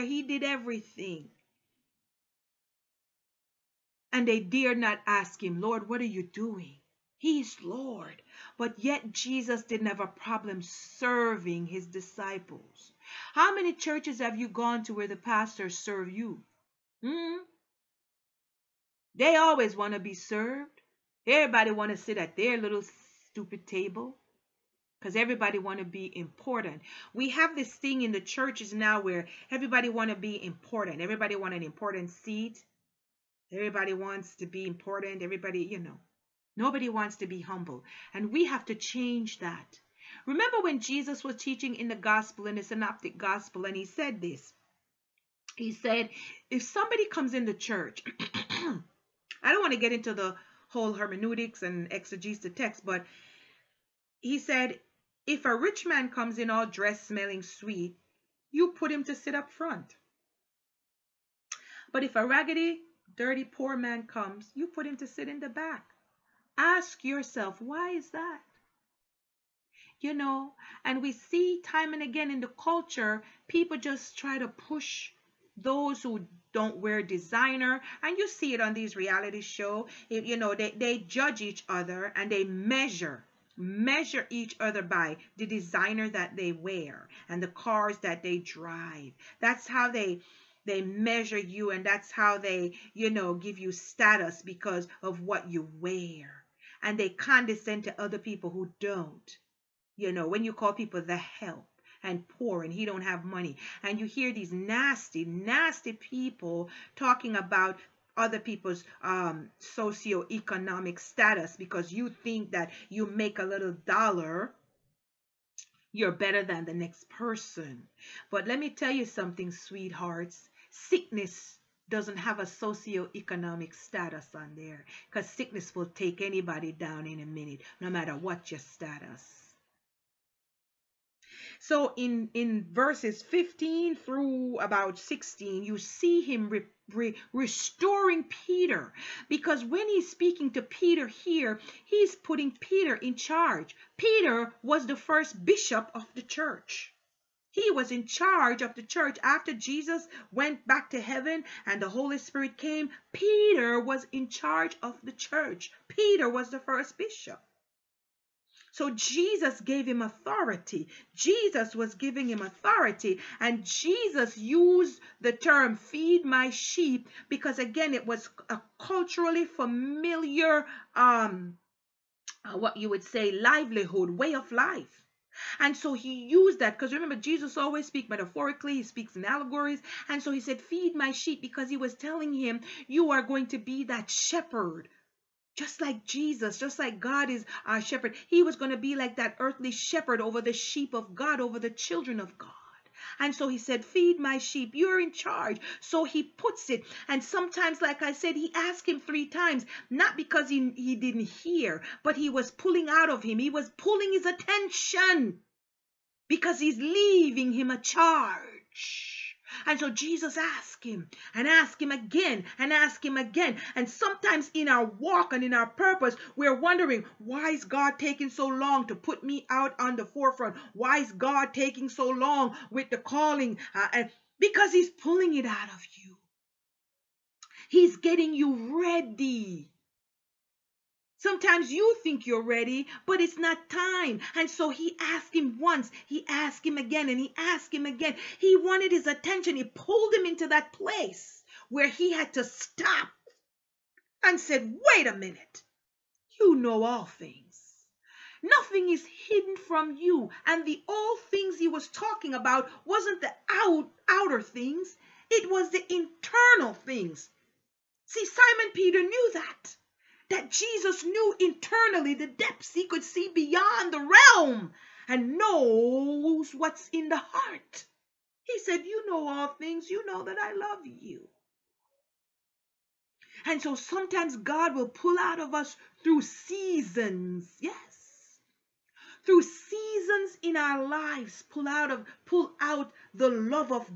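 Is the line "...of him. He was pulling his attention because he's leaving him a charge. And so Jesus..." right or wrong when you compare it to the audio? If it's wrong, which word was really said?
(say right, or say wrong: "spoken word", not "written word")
right.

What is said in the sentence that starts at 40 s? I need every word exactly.
Remember when Jesus was teaching in the gospel, in the synoptic gospel, and he said this.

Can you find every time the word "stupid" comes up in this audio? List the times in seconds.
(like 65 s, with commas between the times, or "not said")
23 s.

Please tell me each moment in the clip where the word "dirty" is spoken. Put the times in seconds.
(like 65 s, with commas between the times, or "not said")
63 s.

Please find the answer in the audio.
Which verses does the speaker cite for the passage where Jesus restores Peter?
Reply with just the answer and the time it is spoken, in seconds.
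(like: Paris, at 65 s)
15 through 16, at 133 s.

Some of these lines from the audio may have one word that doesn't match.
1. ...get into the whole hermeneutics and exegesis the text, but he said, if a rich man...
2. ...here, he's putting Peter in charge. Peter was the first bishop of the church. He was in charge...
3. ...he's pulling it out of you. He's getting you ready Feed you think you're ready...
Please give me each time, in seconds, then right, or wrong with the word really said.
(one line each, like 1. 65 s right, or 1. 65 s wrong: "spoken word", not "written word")
1. 49 s right
2. 141 s right
3. 224 s wrong: "Sometimes", not "Feed".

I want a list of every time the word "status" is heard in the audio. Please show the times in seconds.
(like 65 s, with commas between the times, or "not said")
93 s, 110 s, 123 s, 128 s.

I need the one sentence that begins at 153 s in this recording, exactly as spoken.
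Peter was in charge of the church.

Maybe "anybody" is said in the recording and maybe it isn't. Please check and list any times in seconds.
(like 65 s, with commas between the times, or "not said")
126 s.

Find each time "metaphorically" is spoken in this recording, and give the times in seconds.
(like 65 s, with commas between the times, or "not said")
178 s.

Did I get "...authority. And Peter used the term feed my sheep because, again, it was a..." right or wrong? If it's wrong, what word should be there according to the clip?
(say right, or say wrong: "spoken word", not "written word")
wrong: "Jesus", not "Peter".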